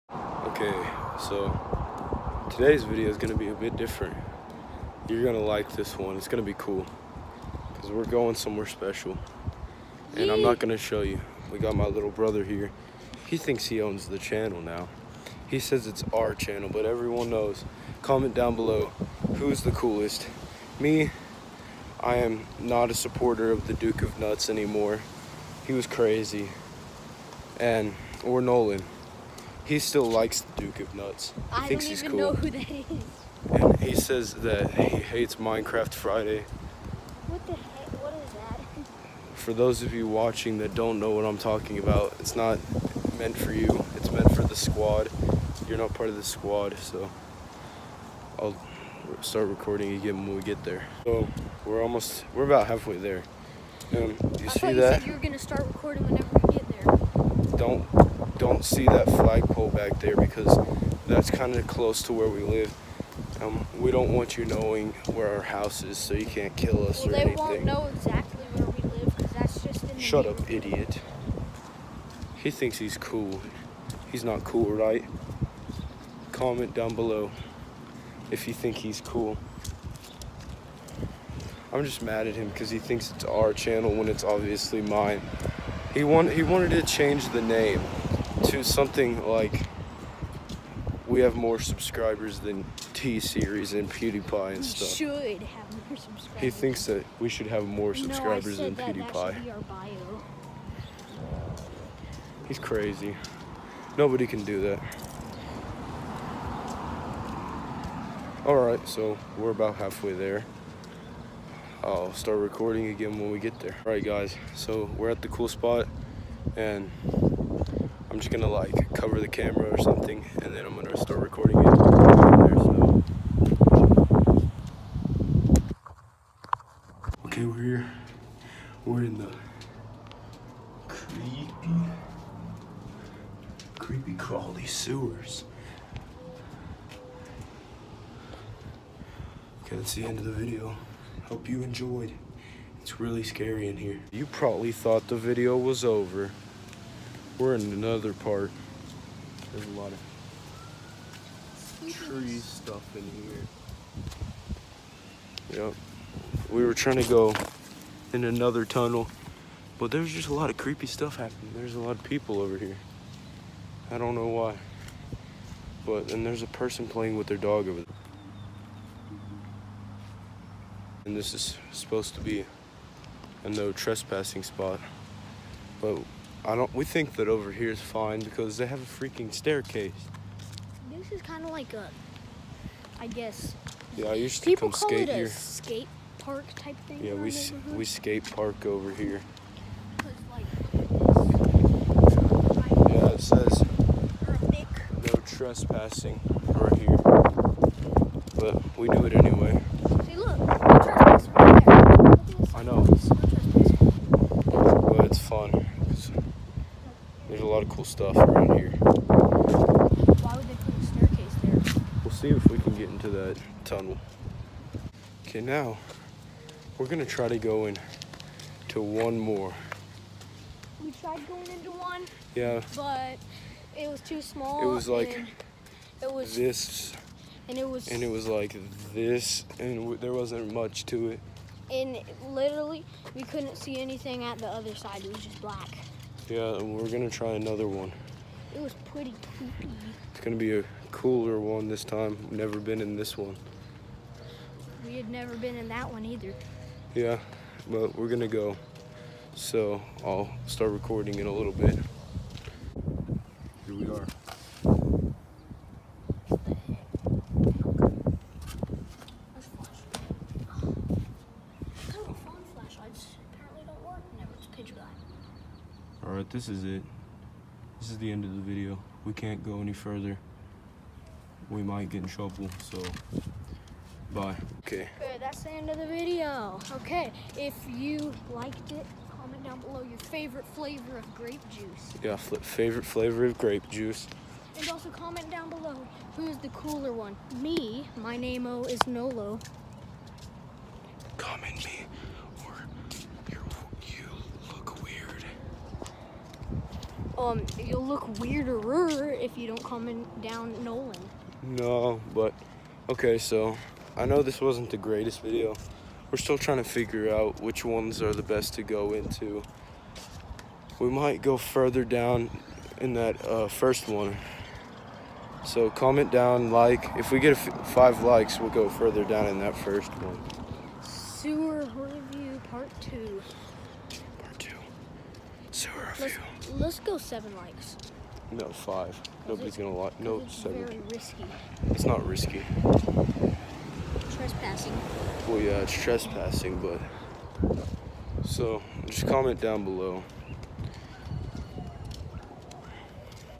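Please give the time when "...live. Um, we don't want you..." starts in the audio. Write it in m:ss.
1:02.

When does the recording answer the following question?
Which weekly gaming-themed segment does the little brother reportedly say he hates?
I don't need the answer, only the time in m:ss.
0:35.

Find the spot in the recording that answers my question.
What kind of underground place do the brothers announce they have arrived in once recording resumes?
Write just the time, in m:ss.
2:14.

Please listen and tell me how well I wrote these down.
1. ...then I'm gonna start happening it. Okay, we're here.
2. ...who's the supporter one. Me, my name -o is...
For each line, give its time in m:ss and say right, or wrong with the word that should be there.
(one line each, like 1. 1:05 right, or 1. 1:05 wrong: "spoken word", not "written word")
1. 2:00 wrong: "recording", not "happening"
2. 4:46 wrong: "cooler", not "supporter".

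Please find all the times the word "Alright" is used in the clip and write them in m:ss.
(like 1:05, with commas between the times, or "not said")
1:48, 1:53.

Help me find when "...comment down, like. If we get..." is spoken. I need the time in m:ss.
5:15.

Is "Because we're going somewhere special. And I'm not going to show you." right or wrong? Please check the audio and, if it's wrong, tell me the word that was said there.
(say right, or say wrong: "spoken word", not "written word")
right.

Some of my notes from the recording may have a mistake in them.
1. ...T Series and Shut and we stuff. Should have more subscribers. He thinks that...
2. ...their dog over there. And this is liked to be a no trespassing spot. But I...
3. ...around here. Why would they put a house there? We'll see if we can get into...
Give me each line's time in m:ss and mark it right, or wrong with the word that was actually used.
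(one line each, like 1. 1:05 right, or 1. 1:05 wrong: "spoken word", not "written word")
1. 1:32 wrong: "PewDiePie", not "Shut"
2. 2:47 wrong: "supposed", not "liked"
3. 3:28 wrong: "staircase", not "house".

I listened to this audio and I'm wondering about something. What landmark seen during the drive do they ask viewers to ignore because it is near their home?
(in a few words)
flagpole.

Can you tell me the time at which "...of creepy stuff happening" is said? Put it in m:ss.
2:40.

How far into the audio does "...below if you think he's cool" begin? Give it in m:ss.
1:16.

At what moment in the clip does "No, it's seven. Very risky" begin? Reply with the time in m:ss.
5:29.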